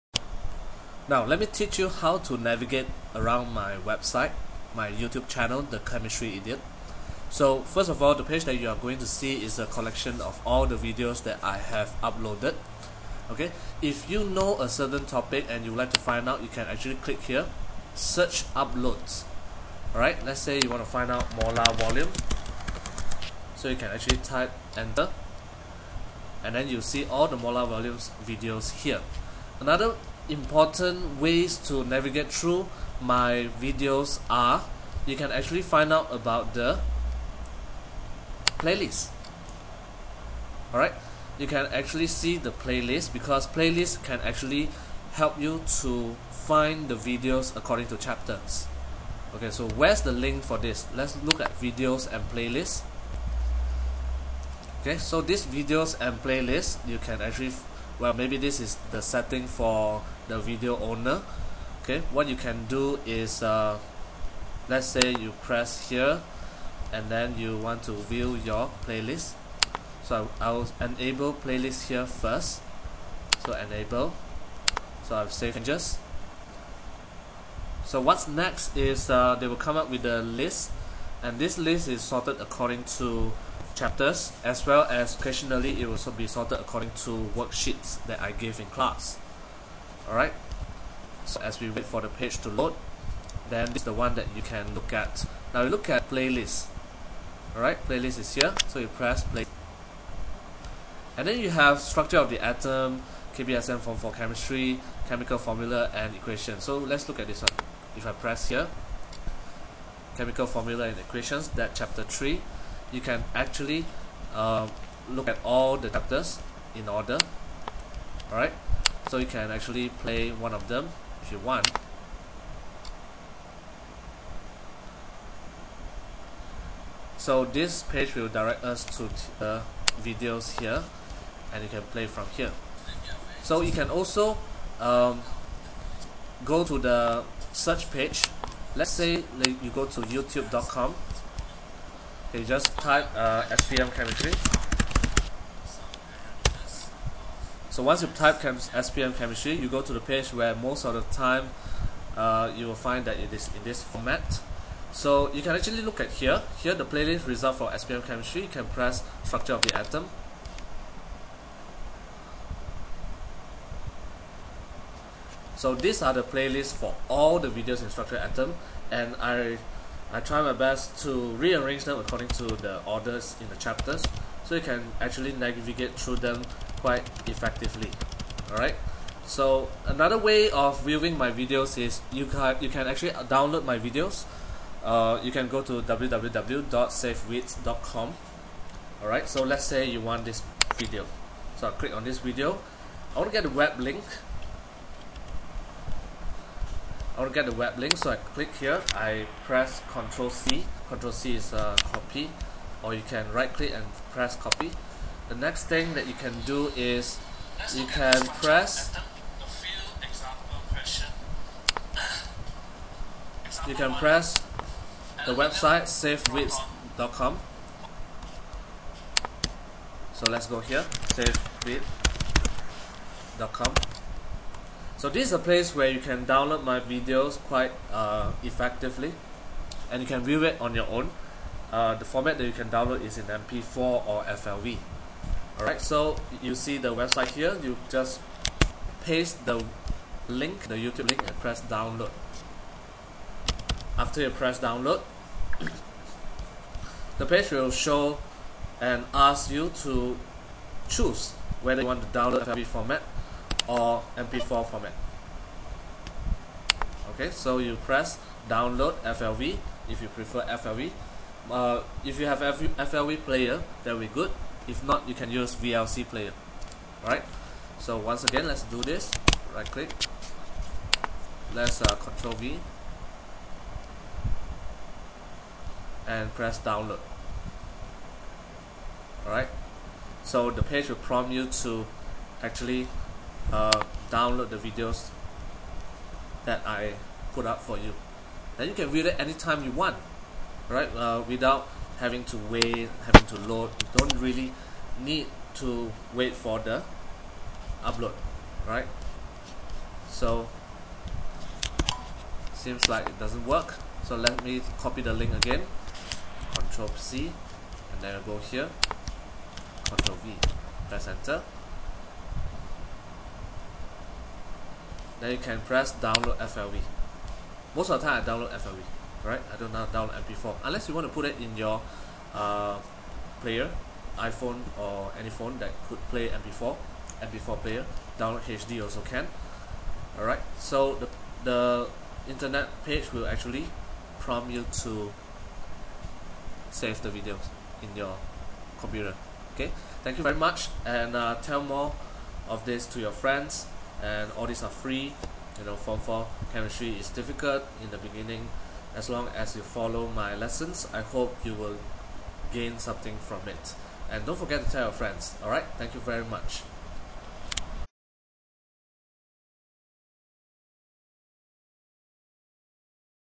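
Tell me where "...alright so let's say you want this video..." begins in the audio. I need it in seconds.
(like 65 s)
189 s.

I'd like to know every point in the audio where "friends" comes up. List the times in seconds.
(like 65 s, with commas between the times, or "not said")
343 s, 354 s.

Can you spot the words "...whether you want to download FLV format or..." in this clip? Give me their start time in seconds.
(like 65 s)
251 s.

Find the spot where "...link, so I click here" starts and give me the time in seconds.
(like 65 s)
197 s.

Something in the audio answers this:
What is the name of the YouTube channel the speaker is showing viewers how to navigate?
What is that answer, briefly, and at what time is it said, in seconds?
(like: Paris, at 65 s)
The Chemistry Idiot, at 5 s.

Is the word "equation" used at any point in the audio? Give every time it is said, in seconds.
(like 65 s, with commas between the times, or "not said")
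106 s, 110 s.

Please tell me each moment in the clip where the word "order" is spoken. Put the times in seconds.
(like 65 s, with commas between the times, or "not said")
116 s, 172 s.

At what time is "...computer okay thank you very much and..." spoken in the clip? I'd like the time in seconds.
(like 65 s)
338 s.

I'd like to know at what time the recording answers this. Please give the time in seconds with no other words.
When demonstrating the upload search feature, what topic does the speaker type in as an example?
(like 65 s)
21 s.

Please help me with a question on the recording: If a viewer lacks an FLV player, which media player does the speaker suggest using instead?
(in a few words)
VLC player.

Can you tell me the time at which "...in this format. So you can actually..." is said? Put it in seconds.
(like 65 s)
153 s.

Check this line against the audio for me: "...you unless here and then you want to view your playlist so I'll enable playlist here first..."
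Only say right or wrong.
wrong.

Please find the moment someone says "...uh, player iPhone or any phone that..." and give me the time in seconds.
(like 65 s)
322 s.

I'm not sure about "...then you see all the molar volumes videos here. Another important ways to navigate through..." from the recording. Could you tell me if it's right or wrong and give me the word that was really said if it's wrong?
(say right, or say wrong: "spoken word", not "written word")
right.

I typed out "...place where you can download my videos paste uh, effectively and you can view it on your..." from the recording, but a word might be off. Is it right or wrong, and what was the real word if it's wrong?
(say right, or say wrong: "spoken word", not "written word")
wrong: "quite", not "paste".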